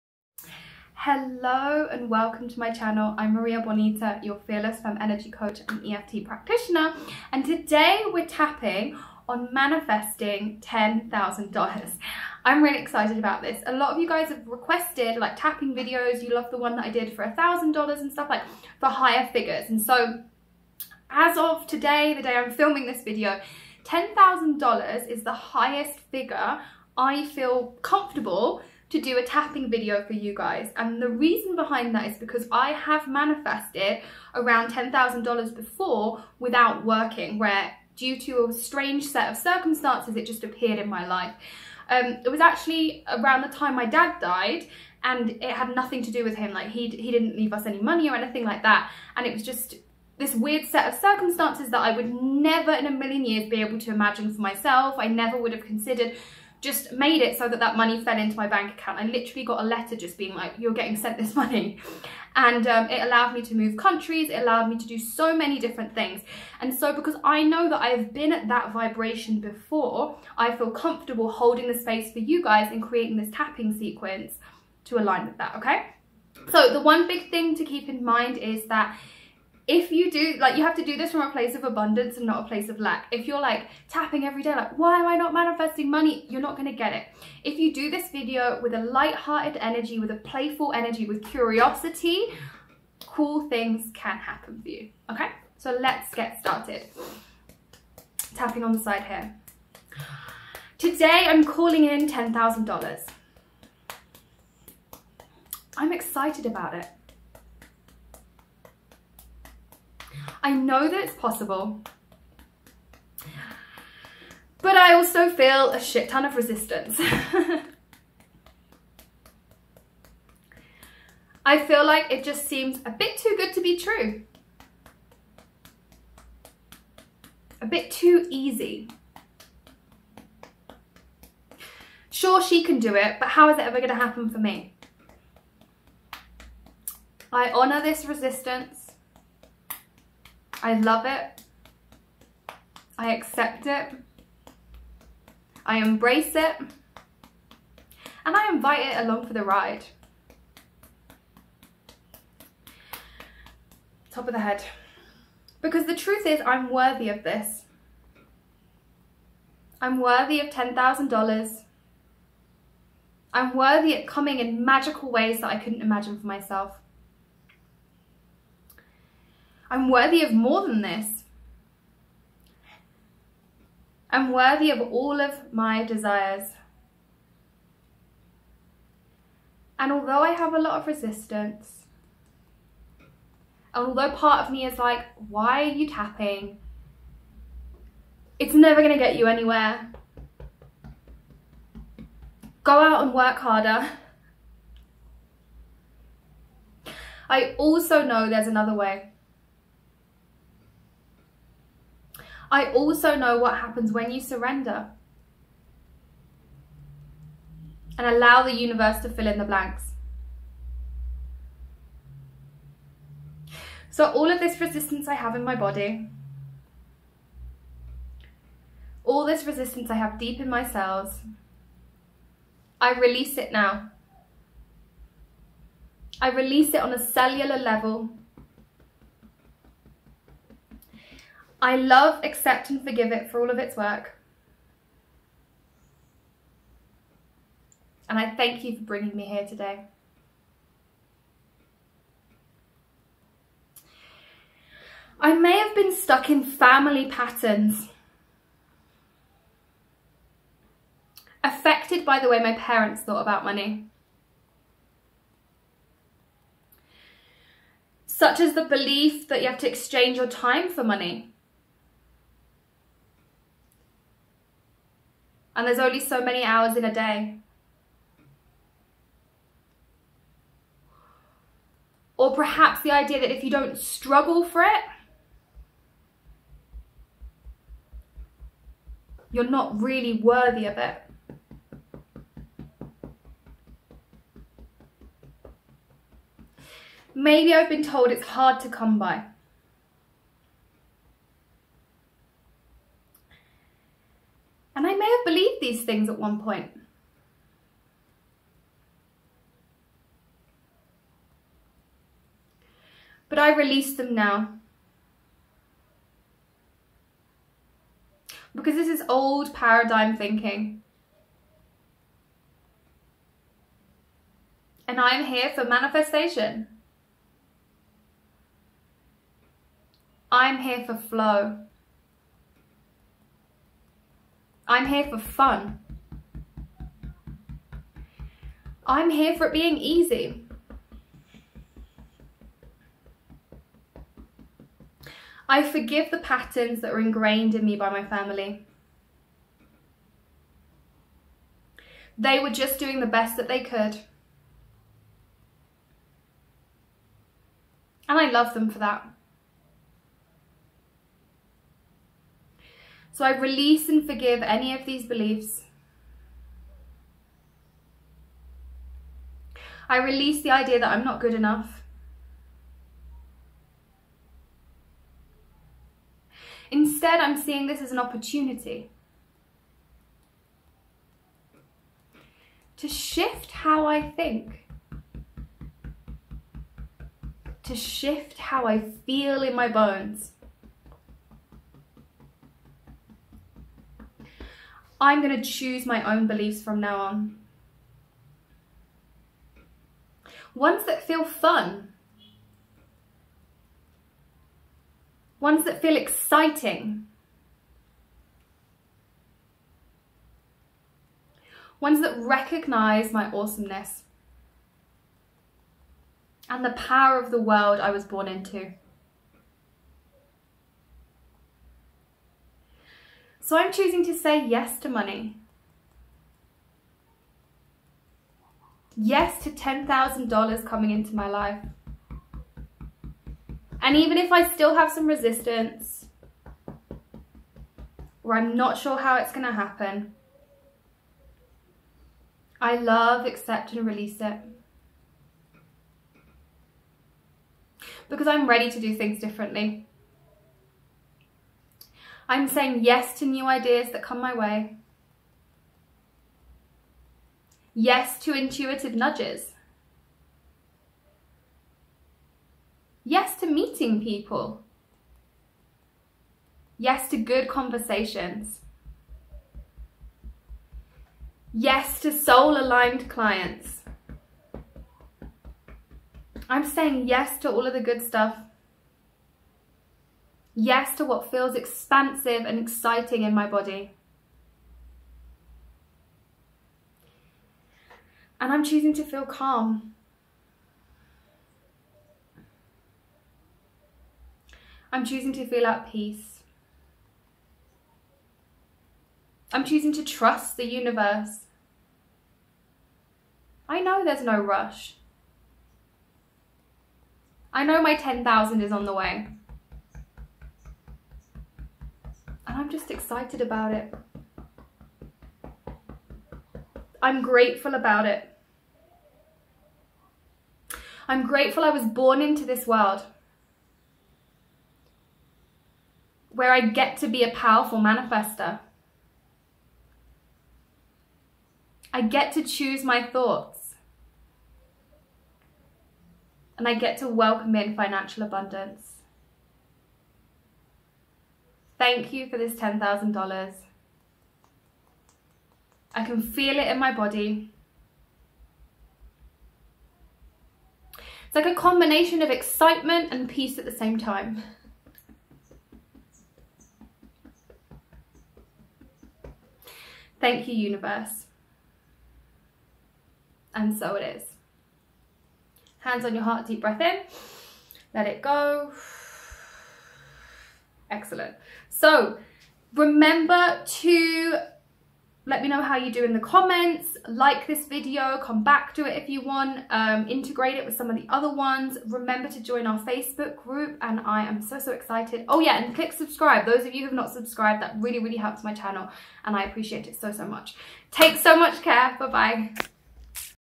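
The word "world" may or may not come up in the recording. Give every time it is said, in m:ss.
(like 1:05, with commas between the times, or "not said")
6:47, 8:32.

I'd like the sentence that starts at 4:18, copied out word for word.
Such as the belief that you have to exchange your time for money.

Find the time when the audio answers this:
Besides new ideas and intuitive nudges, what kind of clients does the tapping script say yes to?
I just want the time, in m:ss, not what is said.
7:42.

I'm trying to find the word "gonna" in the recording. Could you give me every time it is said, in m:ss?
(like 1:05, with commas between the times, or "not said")
1:26, 3:08.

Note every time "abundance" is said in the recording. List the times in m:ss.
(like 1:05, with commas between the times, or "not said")
1:21, 8:48.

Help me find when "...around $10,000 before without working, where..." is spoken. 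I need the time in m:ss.
0:34.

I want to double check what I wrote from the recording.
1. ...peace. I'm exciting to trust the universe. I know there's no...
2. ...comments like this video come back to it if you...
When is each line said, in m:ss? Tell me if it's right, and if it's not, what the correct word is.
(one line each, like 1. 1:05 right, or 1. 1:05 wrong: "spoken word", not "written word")
1. 8:05 wrong: "choosing", not "exciting"
2. 9:26 right.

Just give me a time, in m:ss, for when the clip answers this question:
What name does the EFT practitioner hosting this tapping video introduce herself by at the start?
0:03.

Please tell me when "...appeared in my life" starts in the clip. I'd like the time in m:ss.
0:40.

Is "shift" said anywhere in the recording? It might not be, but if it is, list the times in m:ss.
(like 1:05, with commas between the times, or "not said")
6:12, 6:17.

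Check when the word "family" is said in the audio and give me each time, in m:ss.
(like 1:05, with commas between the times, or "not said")
4:06, 5:38.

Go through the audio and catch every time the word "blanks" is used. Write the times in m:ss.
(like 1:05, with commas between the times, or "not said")
3:29.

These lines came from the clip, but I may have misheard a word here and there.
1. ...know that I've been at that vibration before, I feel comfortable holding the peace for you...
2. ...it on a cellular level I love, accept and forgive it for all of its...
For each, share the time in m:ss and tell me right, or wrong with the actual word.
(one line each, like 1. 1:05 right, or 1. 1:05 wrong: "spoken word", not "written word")
1. 1:07 wrong: "space", not "peace"
2. 3:46 right.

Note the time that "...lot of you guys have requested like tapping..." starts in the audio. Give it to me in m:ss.
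0:13.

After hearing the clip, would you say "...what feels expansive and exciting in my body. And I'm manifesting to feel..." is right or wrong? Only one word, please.
wrong.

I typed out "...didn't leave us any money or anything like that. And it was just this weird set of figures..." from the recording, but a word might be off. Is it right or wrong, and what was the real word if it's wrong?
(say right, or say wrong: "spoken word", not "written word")
wrong: "circumstances", not "figures".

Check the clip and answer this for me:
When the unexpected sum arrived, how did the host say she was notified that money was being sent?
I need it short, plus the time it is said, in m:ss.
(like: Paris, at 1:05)
a letter, at 0:59.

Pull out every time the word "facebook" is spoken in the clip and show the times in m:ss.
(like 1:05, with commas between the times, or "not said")
9:32.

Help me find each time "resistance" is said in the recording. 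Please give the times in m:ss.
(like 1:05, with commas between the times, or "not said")
1:56, 2:18, 3:00, 3:34, 3:39, 7:05.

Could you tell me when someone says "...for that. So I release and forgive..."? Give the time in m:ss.
5:48.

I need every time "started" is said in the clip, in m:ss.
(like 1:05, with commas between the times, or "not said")
1:36.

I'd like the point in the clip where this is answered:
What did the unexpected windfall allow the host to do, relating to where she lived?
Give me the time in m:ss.
1:03.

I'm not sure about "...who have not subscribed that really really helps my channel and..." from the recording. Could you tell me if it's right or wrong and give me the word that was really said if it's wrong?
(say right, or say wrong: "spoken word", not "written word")
right.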